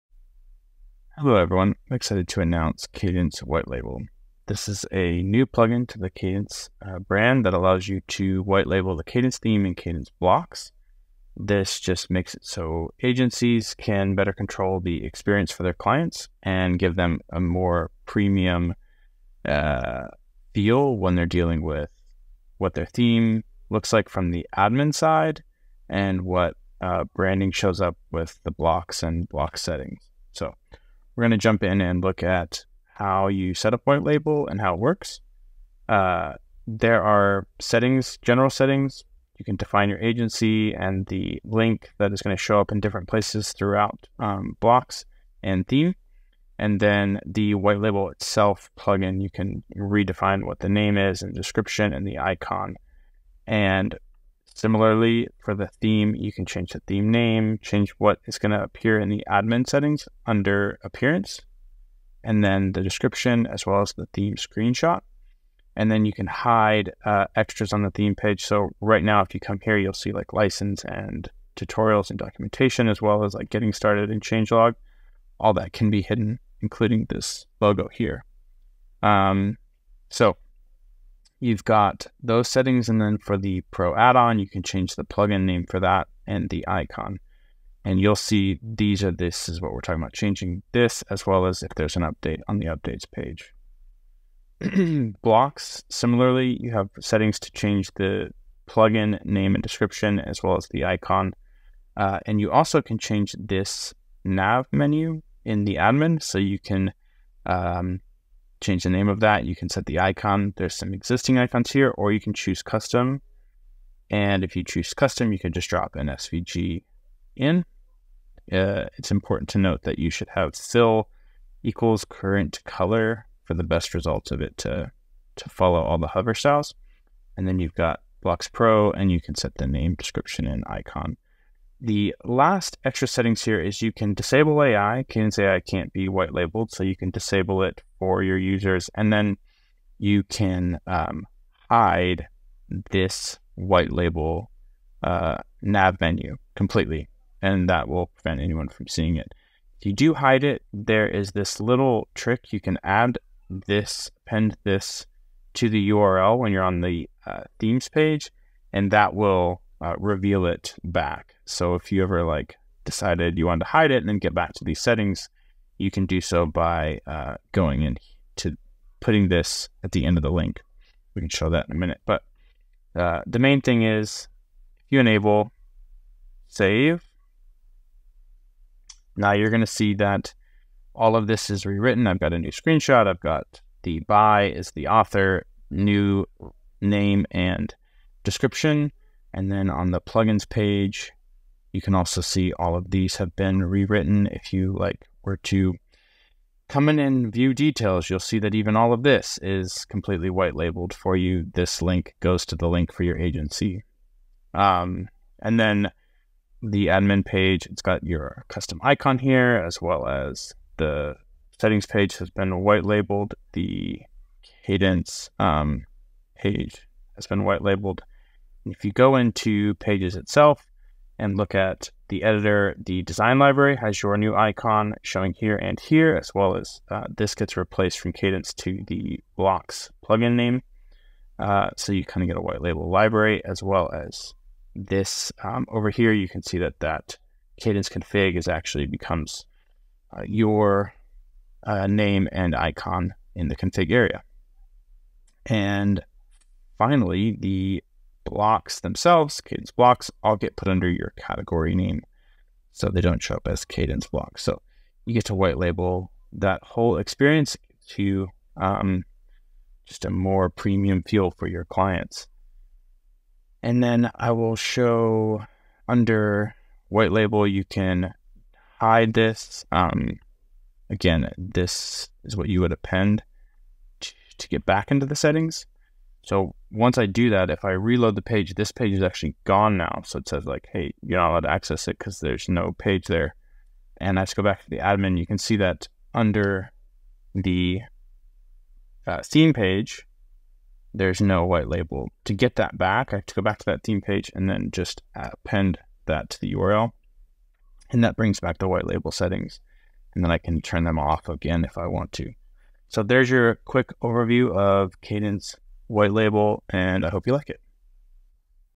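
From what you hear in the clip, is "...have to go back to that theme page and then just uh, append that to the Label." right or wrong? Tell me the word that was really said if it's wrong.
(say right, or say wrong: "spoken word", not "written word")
wrong: "URL", not "Label".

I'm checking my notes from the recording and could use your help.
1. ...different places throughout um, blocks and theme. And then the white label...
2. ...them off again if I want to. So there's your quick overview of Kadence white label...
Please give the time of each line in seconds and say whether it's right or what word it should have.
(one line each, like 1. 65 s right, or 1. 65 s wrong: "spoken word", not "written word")
1. 42 s right
2. 300 s right.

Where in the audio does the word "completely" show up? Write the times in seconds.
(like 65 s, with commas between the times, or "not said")
146 s, 199 s.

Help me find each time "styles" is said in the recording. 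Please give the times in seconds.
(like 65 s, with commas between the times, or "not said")
126 s.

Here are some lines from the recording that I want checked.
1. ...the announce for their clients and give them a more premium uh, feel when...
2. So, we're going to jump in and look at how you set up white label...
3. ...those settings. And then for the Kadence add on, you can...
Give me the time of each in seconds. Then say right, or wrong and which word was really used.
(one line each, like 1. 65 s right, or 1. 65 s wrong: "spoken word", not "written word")
1. 14 s wrong: "experience", not "announce"
2. 30 s right
3. 82 s wrong: "Pro", not "Kadence".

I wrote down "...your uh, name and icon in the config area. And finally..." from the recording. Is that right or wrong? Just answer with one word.
right.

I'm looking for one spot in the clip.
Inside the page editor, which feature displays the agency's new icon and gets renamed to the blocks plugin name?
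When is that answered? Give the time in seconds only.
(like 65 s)
223 s.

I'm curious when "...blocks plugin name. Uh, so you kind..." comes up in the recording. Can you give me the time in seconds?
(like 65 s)
229 s.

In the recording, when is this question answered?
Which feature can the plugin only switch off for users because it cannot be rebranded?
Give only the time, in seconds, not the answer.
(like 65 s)
135 s.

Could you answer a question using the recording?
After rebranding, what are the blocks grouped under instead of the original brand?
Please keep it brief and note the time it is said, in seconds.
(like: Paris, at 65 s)
your category name, at 250 s.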